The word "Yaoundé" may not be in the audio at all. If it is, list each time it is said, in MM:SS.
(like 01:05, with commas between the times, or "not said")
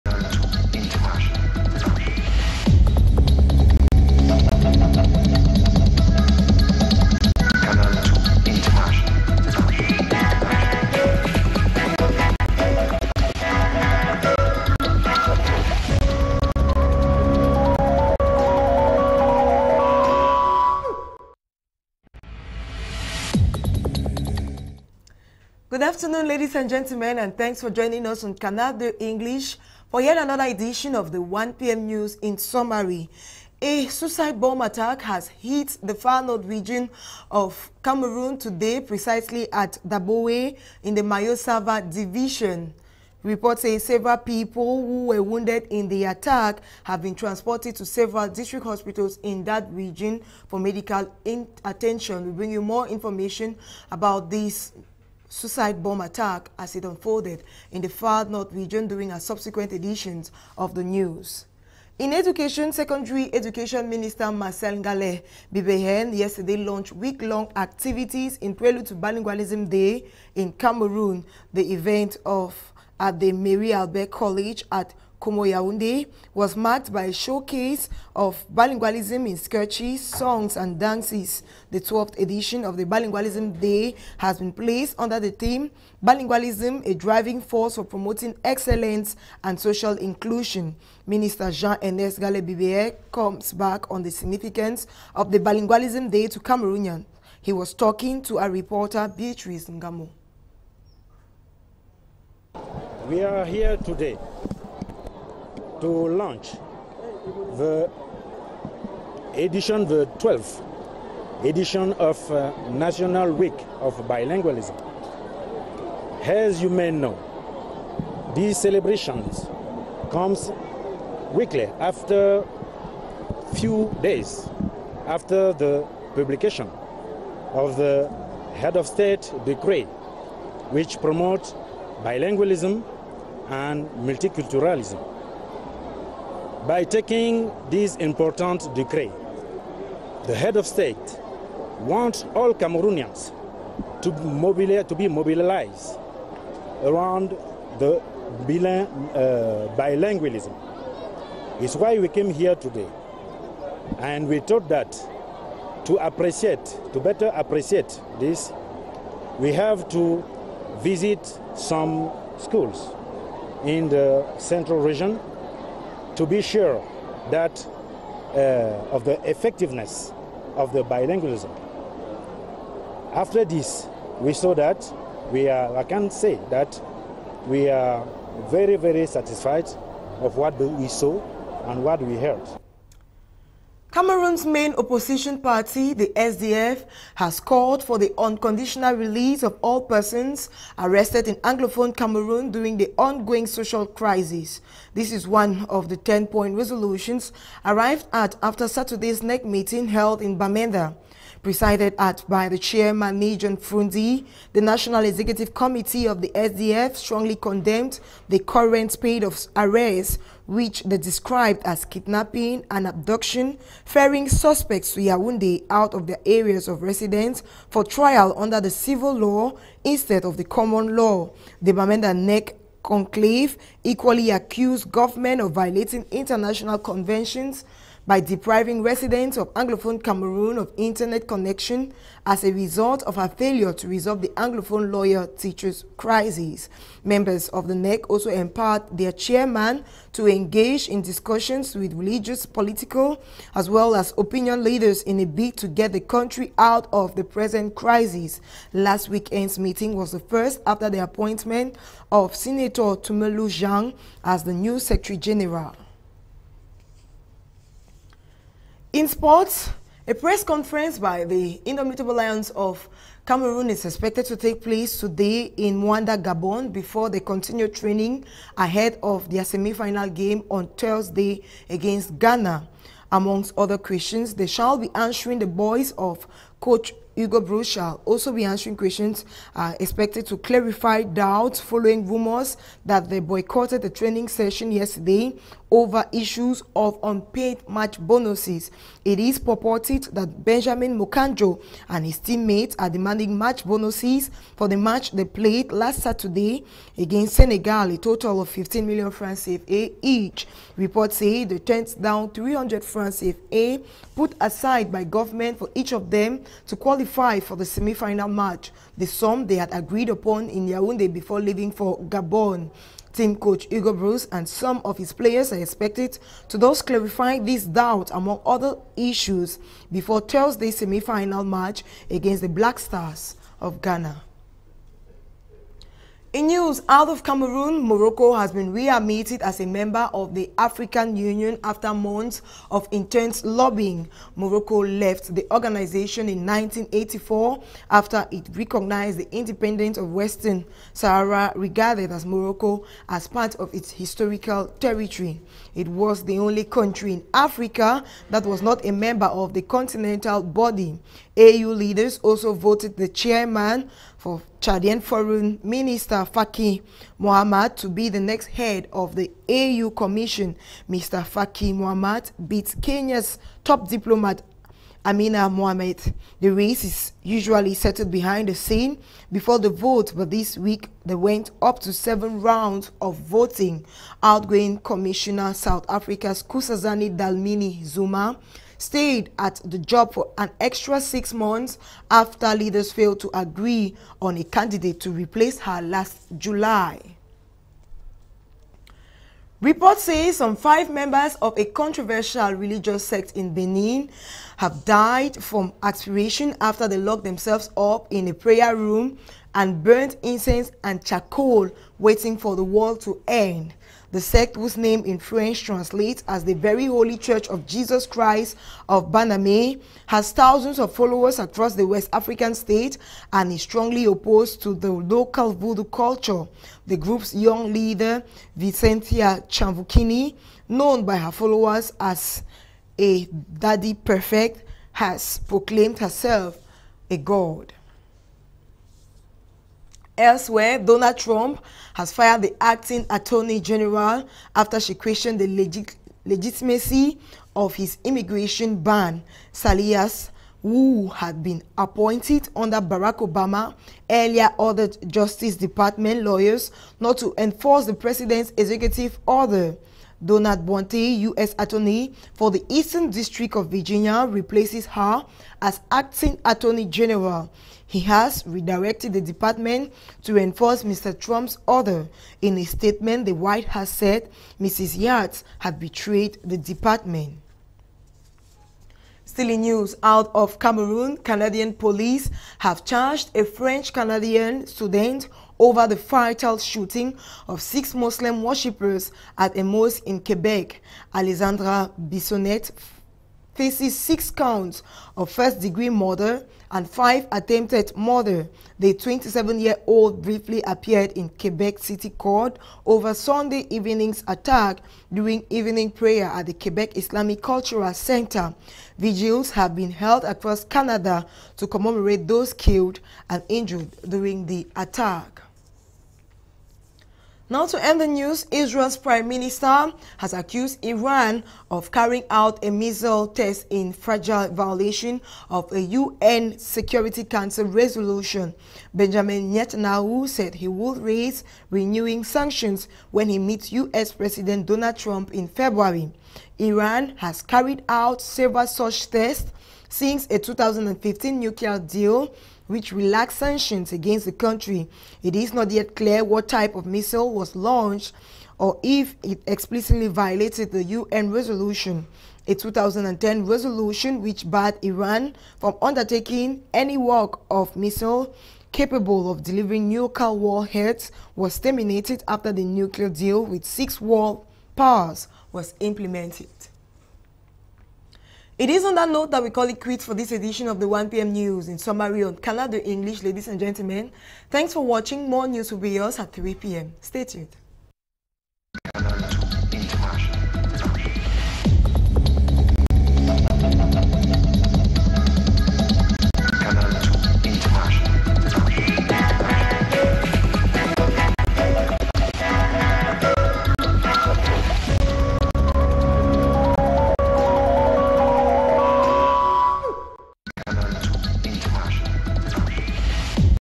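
01:15, 03:34, 05:10.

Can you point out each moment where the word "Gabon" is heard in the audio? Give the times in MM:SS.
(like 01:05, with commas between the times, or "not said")
04:26, 05:12.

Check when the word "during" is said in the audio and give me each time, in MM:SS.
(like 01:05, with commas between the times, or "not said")
00:58, 03:12, 08:15, 08:24.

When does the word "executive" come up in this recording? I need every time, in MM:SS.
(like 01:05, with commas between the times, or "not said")
03:25, 07:28.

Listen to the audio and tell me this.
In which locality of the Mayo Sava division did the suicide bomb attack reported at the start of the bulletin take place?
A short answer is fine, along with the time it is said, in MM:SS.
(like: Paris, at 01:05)
Daboé, at 00:39.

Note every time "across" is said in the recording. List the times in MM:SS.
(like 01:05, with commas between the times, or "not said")
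06:51, 08:20.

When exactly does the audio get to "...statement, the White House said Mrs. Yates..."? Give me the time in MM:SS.
07:42.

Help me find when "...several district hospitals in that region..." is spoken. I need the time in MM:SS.
00:47.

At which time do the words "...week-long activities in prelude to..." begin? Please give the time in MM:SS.
01:06.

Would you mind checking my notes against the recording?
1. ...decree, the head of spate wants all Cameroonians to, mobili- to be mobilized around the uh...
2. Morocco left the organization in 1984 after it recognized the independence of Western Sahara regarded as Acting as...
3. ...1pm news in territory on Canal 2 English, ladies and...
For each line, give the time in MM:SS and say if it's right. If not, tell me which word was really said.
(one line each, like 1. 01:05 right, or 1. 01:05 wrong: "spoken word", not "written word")
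1. 02:18 wrong: "state", not "spate"
2. 05:34 wrong: "Morocco", not "Acting"
3. 09:20 wrong: "summary", not "territory".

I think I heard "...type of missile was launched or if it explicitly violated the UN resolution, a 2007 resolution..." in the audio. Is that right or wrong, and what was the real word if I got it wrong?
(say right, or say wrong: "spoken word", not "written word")
wrong: "2010", not "2007".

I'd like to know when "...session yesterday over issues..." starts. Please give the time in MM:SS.
04:44.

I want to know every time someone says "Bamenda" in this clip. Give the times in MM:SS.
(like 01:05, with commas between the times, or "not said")
03:20, 03:41.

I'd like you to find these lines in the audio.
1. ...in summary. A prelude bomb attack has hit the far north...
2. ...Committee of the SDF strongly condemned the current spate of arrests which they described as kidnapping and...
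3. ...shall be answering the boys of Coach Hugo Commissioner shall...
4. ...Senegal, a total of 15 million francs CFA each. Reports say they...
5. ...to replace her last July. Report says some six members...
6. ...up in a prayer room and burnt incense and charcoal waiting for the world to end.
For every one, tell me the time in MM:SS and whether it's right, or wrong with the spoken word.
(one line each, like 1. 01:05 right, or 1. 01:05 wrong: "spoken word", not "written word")
1. 00:32 wrong: "suicide", not "prelude"
2. 03:25 right
3. 04:34 wrong: "Broos", not "Commissioner"
4. 04:57 right
5. 06:24 wrong: "five", not "six"
6. 06:37 right.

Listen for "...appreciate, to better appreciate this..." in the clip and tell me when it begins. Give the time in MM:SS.
02:35.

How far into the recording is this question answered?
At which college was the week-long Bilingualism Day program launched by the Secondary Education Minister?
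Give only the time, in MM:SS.
01:13.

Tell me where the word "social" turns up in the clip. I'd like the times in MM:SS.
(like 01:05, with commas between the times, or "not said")
01:29, 03:13.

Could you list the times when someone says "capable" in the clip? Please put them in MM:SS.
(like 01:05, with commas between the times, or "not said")
09:08.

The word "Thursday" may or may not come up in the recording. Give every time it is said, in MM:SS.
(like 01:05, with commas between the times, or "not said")
04:30, 05:20.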